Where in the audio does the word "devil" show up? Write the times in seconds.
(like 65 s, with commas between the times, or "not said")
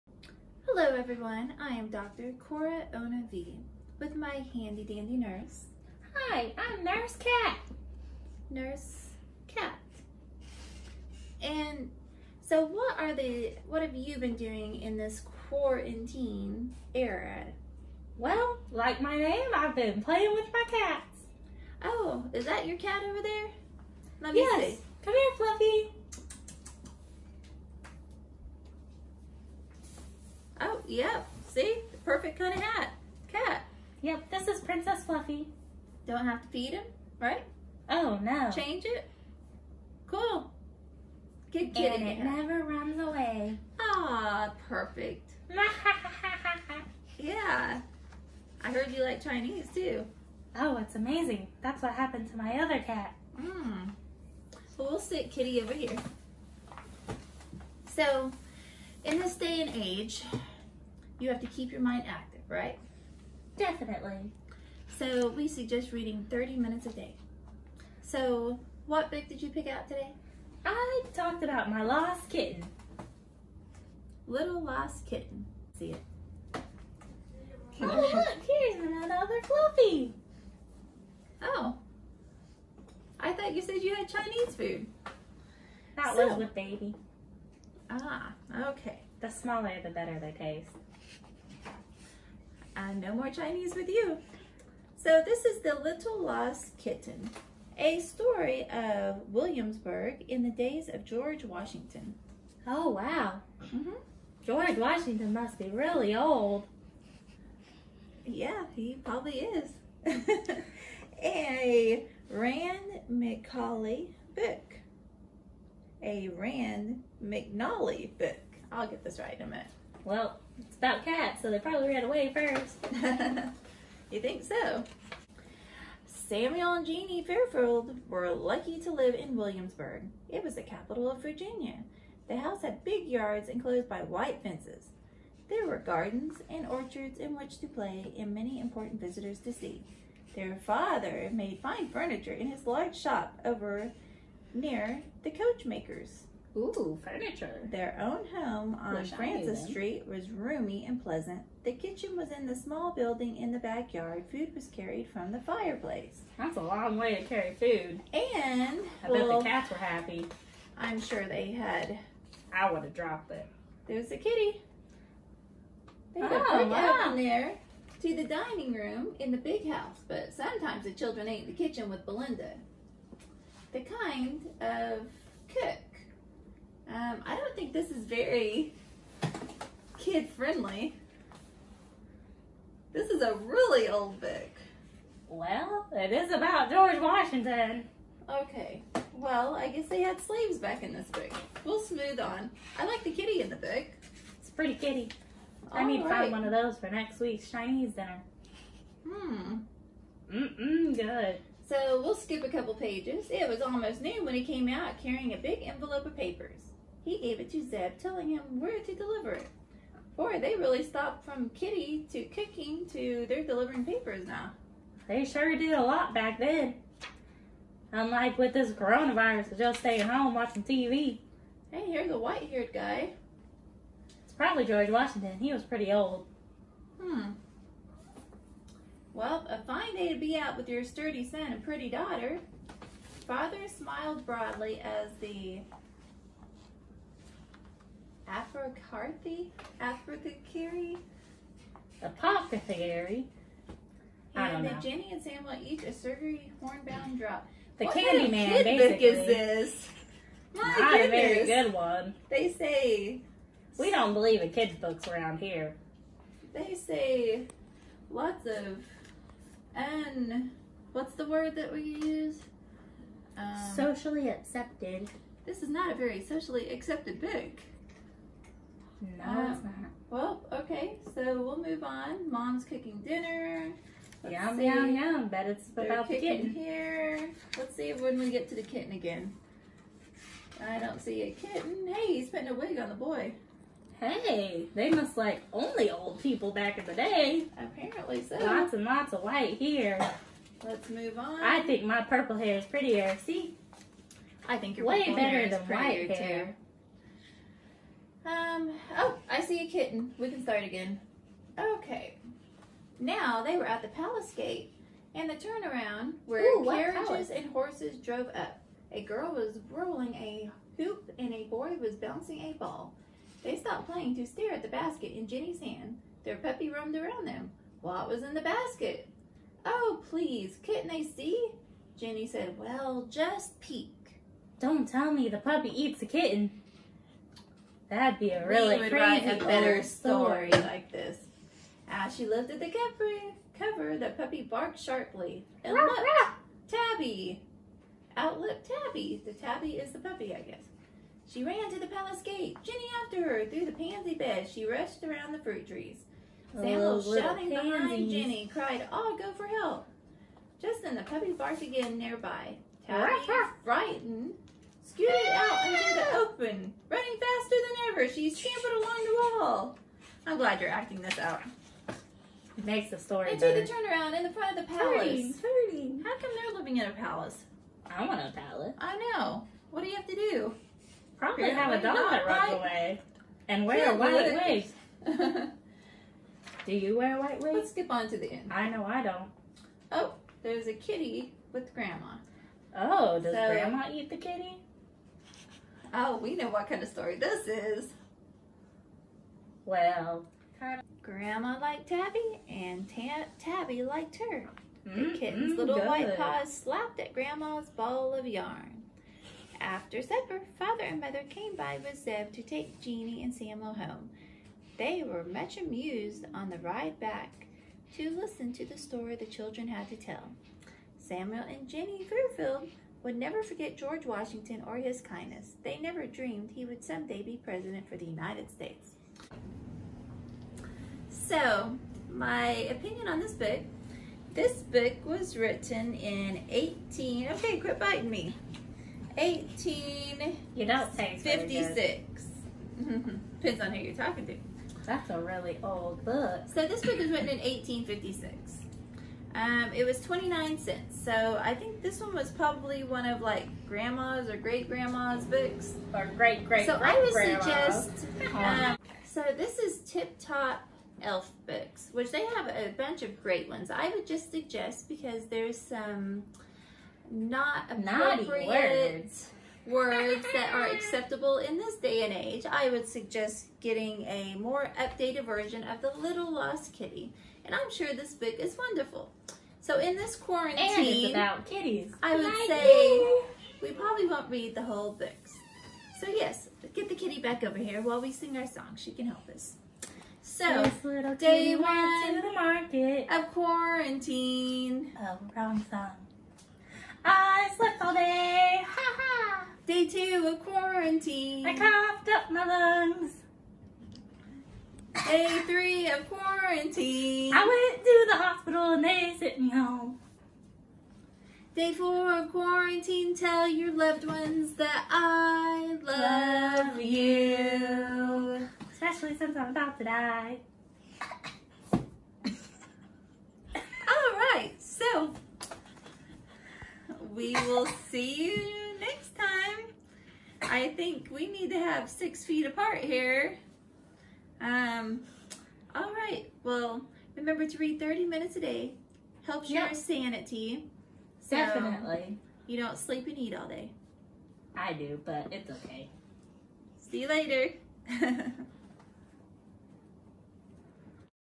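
not said.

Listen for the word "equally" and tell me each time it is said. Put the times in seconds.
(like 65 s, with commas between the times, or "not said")
not said.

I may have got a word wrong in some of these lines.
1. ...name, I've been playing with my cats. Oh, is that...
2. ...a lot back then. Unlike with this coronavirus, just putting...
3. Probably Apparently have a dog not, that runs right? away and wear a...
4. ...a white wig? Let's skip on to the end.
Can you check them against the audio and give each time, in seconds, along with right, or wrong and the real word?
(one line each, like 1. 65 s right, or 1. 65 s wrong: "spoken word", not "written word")
1. 19 s right
2. 215 s wrong: "staying", not "putting"
3. 371 s right
4. 377 s right.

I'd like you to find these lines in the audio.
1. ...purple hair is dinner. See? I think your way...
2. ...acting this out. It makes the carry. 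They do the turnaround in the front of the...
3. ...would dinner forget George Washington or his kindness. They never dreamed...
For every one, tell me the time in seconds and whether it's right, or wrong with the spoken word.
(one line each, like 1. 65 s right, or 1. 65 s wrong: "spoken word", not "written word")
1. 292 s wrong: "prettier", not "dinner"
2. 360 s wrong: "story", not "carry"
3. 413 s wrong: "never", not "dinner".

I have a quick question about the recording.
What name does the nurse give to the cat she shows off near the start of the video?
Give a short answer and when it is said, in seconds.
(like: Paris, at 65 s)
Princess Fluffy, at 34 s.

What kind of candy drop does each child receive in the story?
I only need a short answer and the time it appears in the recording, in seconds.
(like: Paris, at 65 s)
horehound drop, at 246 s.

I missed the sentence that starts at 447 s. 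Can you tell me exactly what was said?
suggest, um, so this is Tip Top Elf Books, which they have a bunch of great ones.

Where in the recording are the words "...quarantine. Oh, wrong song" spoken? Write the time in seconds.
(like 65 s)
483 s.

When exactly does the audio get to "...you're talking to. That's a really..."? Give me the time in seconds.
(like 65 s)
433 s.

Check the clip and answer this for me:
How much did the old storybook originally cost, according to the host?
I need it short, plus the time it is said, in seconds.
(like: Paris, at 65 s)
29 cents, at 440 s.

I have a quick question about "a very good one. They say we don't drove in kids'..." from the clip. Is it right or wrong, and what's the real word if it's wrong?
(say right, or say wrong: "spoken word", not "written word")
wrong: "believe", not "drove".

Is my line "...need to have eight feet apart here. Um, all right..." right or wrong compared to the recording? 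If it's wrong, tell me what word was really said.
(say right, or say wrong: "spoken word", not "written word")
wrong: "six", not "eight".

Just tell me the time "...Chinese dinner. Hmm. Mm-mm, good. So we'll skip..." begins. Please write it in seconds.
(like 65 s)
197 s.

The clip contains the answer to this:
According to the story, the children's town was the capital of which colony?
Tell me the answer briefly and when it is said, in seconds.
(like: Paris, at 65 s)
Virginia, at 131 s.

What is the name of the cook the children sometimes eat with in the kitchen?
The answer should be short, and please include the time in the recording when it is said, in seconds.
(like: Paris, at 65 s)
Belinda, at 172 s.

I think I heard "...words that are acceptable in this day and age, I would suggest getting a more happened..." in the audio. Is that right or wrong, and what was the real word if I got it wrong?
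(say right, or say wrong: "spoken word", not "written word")
wrong: "updated", not "happened".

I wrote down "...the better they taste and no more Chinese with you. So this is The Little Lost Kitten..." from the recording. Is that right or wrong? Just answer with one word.
right.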